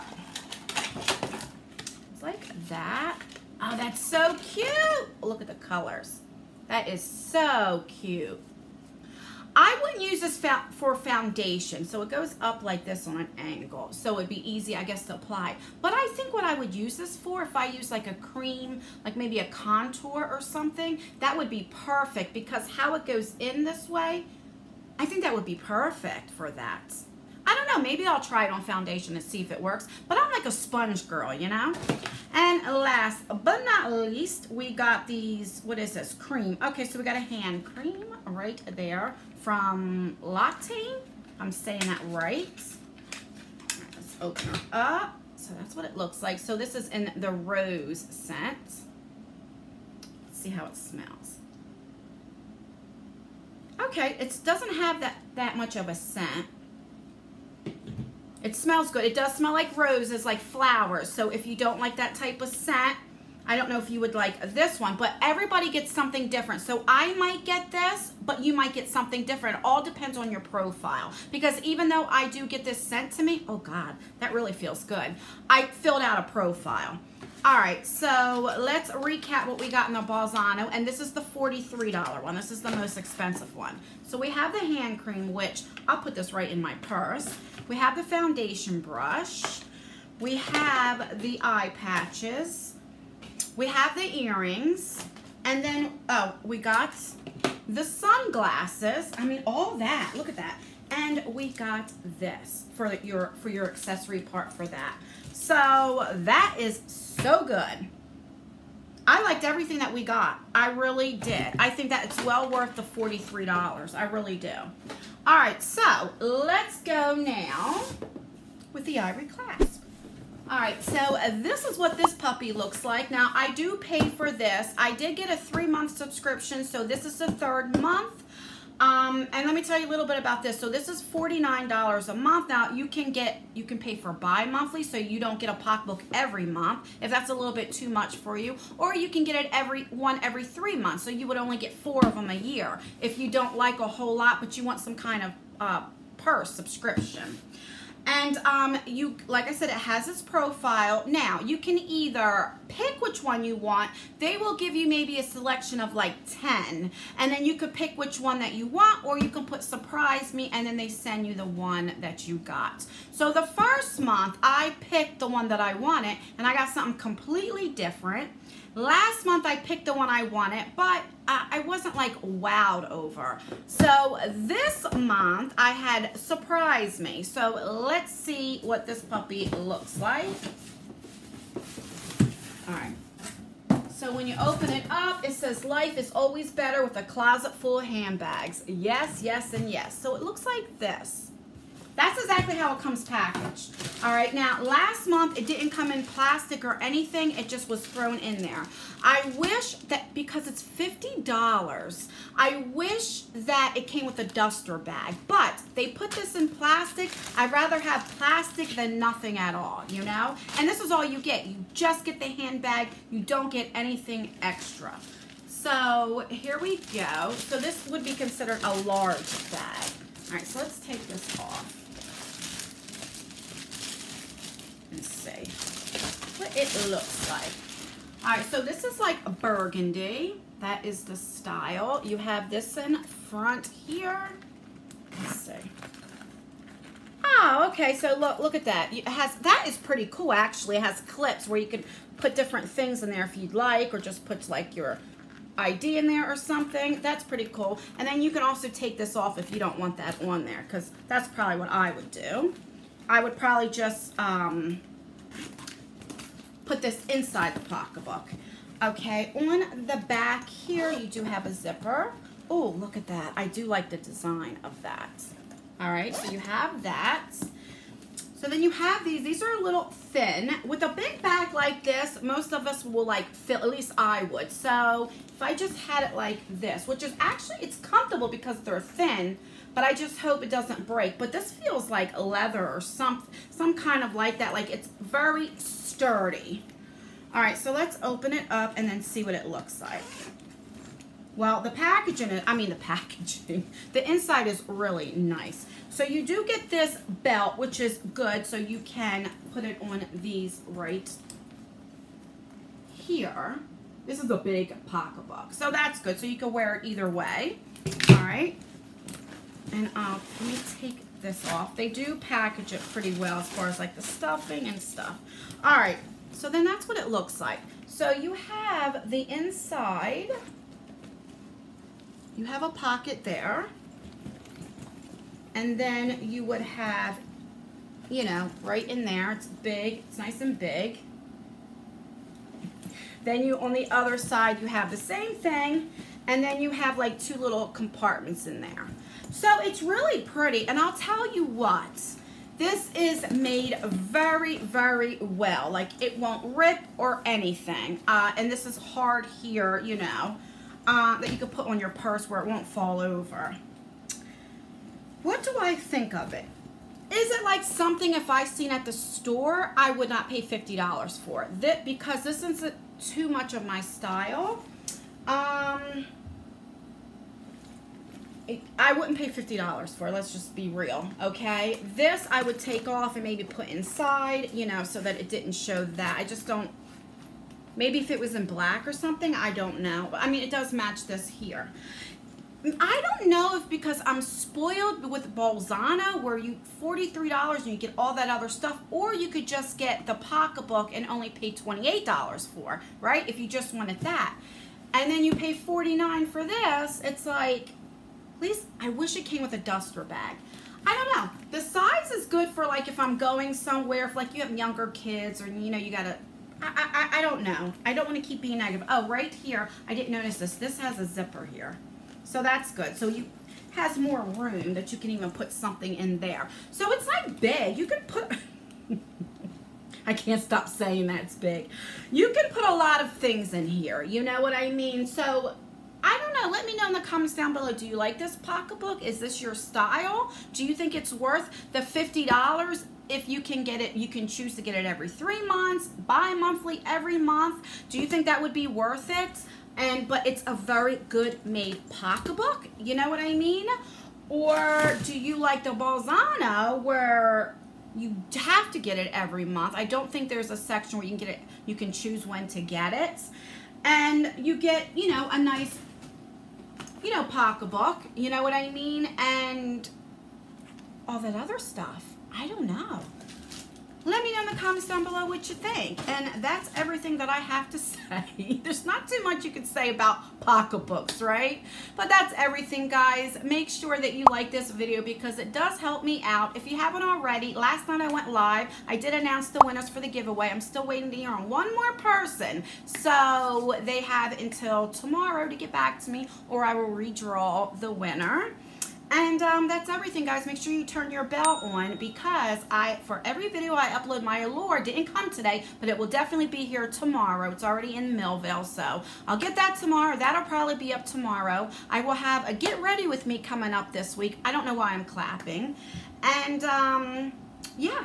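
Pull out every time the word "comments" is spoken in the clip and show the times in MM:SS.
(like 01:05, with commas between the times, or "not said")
07:06, 07:44.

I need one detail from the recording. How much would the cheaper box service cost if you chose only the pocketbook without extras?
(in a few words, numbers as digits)
$28.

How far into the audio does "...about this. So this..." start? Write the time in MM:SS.
02:10.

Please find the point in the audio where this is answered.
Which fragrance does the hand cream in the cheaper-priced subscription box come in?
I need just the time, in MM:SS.
00:47.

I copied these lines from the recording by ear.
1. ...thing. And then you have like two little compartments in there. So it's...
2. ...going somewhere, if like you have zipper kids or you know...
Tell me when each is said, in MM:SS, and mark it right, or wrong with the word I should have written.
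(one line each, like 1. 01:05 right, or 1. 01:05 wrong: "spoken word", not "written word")
1. 05:35 right
2. 06:43 wrong: "younger", not "zipper".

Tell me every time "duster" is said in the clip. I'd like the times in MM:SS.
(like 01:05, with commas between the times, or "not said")
03:24, 06:39.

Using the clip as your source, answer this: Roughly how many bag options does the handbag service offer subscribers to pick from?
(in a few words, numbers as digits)
10.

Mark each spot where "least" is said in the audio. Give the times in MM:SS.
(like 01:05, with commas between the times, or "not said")
00:33, 04:33, 06:38.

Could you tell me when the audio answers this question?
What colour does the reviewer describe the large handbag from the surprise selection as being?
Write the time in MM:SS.
03:49.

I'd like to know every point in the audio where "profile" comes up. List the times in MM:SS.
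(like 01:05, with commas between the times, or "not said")
01:10, 01:16, 02:30.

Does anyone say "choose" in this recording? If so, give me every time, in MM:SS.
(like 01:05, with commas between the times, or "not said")
07:14, 07:31.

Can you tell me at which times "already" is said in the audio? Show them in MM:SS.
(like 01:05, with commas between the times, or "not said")
07:57, 08:17.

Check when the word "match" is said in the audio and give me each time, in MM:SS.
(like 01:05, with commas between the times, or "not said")
06:20.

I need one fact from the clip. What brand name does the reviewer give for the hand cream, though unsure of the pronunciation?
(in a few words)
Lotte.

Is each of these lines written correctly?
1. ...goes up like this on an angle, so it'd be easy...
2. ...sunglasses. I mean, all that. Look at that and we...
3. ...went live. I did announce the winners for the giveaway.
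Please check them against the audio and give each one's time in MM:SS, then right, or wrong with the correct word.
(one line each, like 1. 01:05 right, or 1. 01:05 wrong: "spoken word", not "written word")
1. 00:12 right
2. 01:37 right
3. 07:58 right.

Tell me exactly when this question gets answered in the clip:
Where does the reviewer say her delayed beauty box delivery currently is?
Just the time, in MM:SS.
08:18.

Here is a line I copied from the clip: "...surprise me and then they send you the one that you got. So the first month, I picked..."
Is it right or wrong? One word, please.
right.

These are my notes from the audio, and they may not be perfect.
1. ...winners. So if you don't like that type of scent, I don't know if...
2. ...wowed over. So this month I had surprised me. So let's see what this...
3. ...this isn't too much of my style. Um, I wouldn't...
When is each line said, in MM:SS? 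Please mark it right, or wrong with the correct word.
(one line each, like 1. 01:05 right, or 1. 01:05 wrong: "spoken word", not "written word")
1. 01:00 wrong: "flowers", not "winners"
2. 02:52 right
3. 06:02 right.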